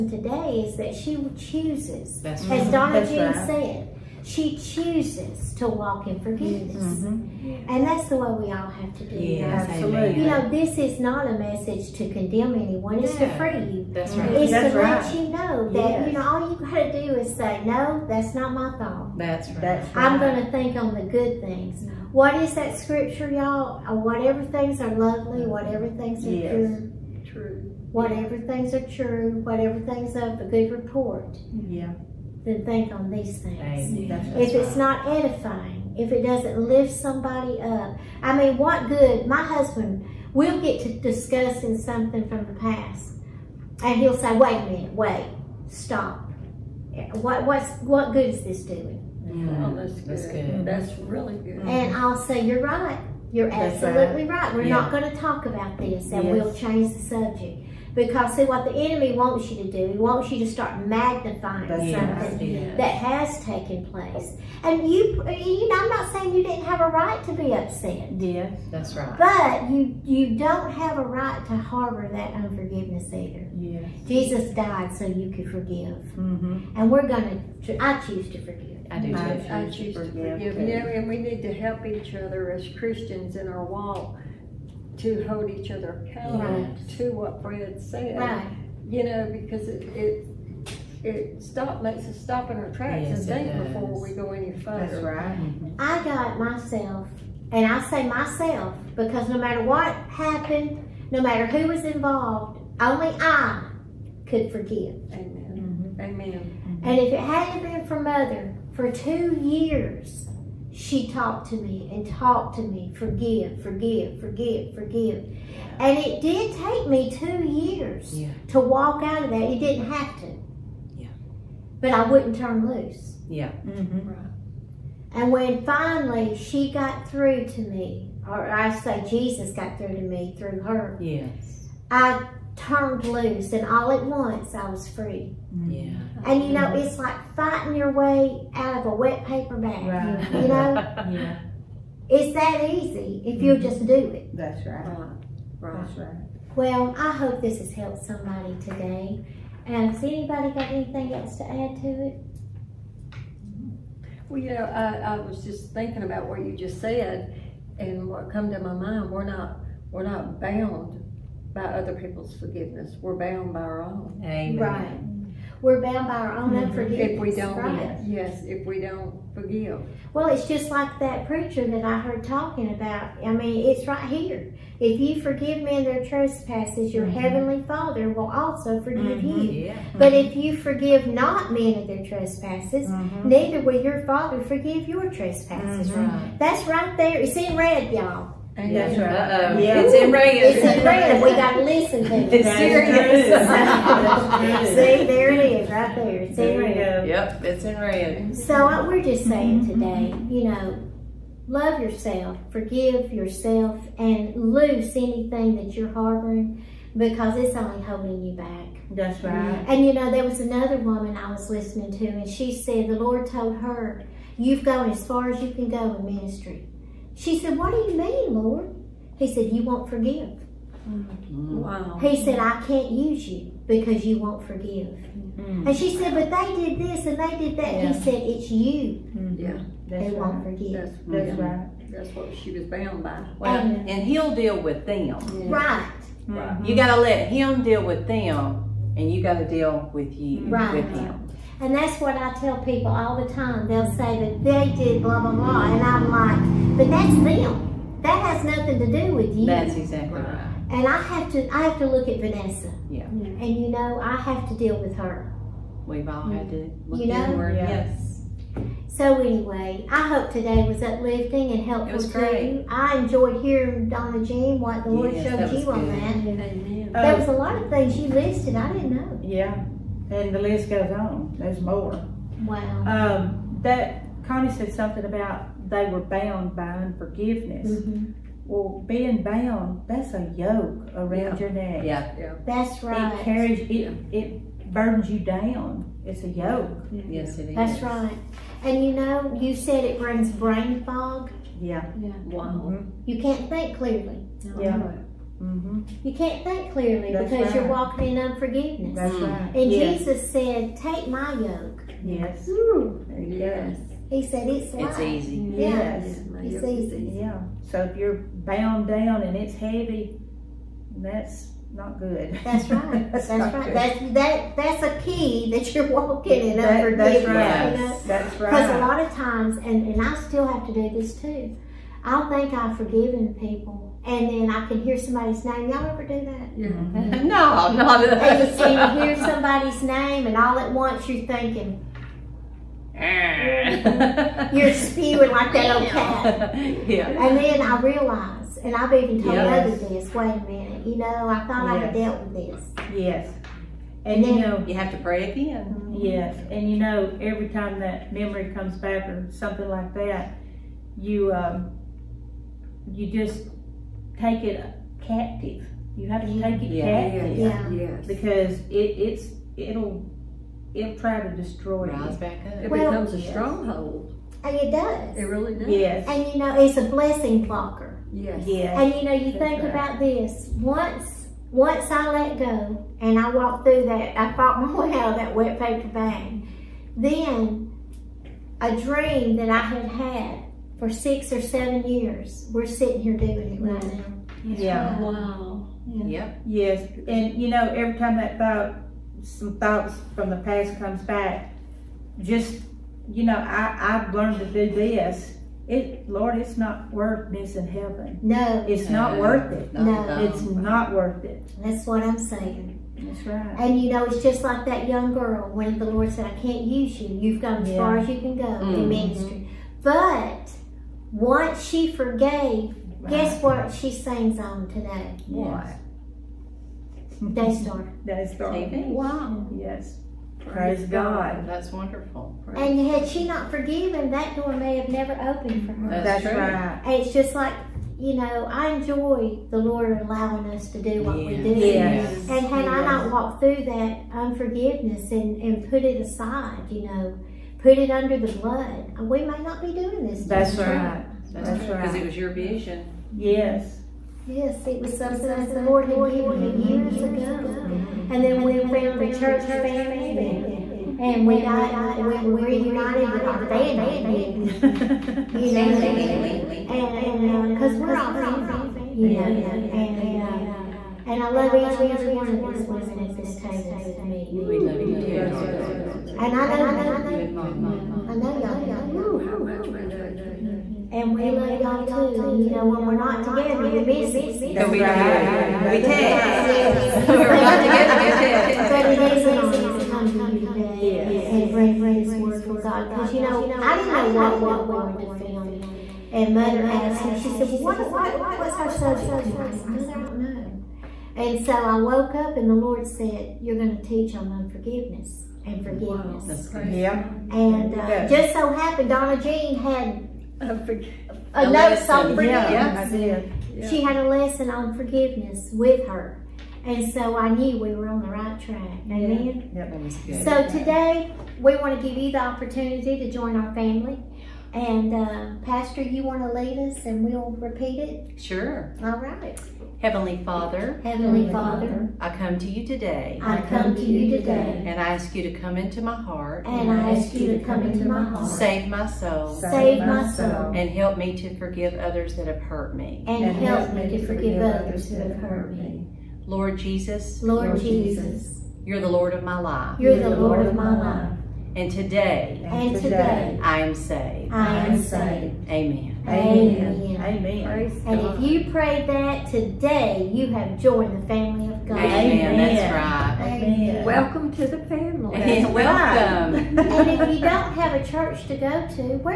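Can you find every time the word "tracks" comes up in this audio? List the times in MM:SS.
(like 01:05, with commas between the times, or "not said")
01:32, 08:28.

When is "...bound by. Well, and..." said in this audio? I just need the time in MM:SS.
03:52.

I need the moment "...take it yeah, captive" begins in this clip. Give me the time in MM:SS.
05:56.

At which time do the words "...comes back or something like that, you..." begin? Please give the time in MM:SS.
05:48.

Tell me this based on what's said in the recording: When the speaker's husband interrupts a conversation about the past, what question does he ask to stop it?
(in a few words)
What good is this doing?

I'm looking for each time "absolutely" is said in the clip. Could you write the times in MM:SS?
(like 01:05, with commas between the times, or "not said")
00:09, 00:53.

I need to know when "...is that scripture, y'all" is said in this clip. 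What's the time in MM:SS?
00:22.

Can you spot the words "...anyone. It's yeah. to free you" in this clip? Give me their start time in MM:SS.
00:12.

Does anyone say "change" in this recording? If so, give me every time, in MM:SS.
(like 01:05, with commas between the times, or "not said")
00:56.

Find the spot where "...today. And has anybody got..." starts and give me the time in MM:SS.
02:28.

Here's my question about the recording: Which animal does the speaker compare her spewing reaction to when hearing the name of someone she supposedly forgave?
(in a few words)
Cat.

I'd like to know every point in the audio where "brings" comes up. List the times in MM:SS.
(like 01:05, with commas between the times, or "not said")
04:49, 08:01.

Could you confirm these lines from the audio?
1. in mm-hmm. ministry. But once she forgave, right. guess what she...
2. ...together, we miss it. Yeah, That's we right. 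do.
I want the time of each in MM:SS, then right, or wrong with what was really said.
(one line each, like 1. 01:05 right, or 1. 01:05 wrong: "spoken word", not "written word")
1. 06:48 right
2. 07:53 right.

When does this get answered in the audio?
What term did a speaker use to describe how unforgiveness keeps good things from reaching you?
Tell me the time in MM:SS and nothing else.
06:06.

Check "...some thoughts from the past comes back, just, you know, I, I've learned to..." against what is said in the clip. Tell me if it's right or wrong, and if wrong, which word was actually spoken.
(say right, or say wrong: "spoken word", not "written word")
right.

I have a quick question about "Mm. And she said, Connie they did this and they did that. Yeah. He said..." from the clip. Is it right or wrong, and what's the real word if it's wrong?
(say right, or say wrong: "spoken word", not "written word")
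wrong: "But", not "Connie".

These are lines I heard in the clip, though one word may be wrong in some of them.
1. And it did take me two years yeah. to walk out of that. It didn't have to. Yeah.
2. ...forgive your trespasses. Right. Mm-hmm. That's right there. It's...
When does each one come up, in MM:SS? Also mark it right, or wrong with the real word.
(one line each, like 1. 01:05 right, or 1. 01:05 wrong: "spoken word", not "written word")
1. 01:55 right
2. 03:04 right.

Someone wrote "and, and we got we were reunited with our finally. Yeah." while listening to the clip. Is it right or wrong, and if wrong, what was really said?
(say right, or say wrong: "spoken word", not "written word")
wrong: "family", not "finally".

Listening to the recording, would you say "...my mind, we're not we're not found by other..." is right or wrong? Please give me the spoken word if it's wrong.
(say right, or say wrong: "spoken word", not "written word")
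wrong: "bound", not "found".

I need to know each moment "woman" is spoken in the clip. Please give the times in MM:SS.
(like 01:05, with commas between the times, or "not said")
03:30.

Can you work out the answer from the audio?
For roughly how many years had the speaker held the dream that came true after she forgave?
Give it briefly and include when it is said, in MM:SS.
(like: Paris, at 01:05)
6 or 7, at 06:20.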